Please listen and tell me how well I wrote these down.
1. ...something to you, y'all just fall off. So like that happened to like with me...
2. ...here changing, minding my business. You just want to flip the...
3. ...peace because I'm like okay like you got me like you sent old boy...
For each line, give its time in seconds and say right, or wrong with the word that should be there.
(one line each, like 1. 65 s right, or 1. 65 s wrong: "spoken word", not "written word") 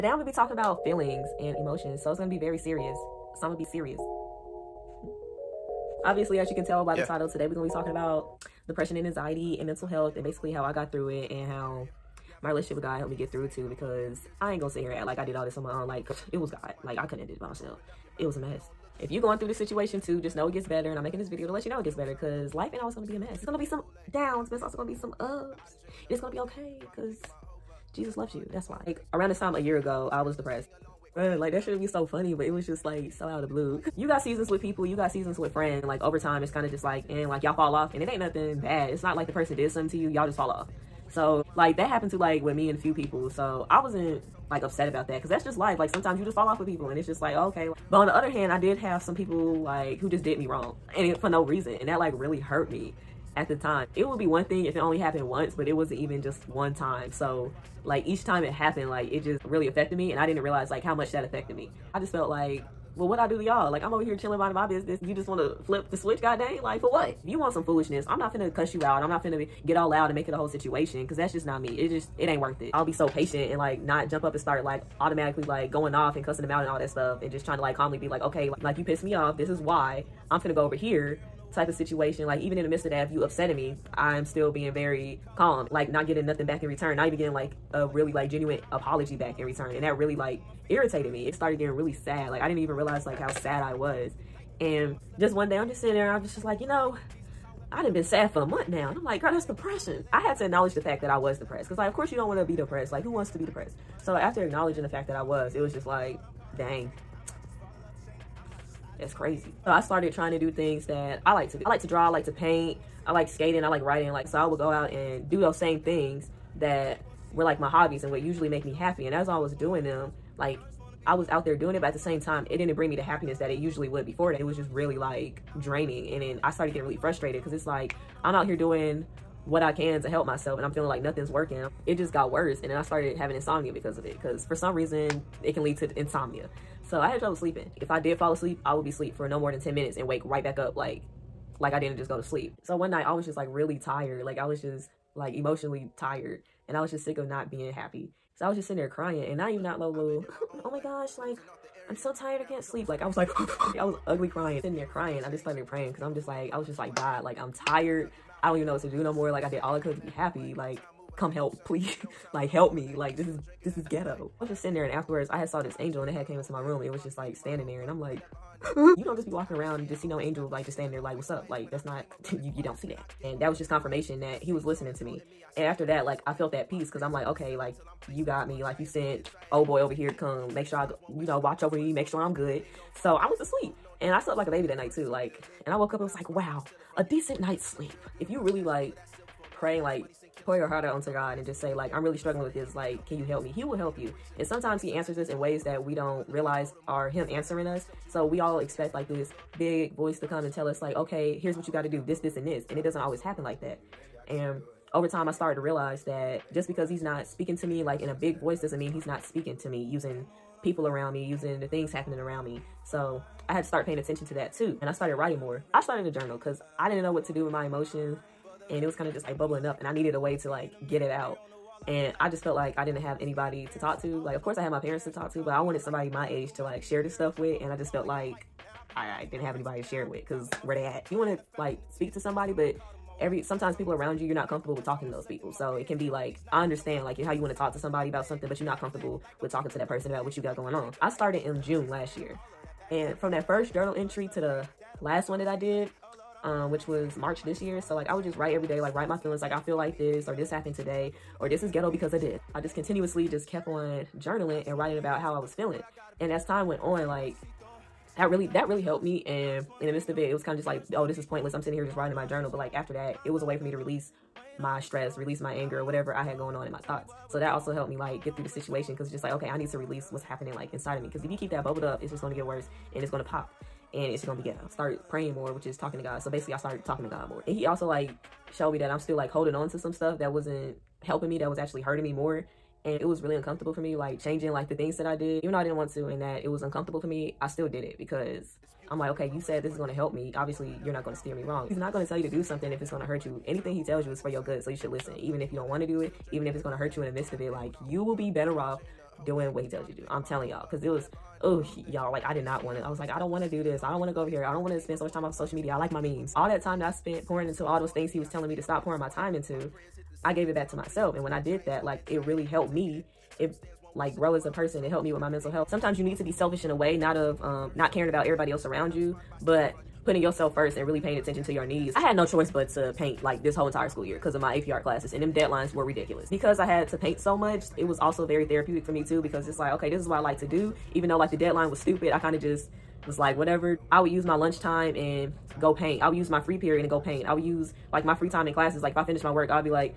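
1. 39 s right
2. 64 s wrong: "chilling", not "changing"
3. 176 s right.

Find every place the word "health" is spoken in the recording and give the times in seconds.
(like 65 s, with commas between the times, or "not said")
9 s, 315 s.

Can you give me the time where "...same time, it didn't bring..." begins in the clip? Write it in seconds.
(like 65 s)
121 s.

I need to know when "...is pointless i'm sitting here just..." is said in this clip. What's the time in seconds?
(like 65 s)
261 s.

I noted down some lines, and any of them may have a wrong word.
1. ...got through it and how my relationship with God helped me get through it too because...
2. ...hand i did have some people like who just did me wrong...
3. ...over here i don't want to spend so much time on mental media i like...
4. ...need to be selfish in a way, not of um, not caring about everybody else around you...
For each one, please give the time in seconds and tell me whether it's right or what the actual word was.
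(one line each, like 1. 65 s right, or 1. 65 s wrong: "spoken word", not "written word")
1. 10 s right
2. 48 s right
3. 304 s wrong: "social", not "mental"
4. 316 s right.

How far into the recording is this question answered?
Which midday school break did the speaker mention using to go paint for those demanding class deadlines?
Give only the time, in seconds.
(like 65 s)
334 s.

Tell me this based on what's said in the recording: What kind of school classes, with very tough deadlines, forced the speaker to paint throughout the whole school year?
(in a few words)
AP art.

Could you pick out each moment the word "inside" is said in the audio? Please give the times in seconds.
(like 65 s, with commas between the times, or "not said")
270 s.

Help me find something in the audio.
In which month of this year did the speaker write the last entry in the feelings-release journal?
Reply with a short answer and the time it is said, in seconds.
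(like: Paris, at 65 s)
March, at 247 s.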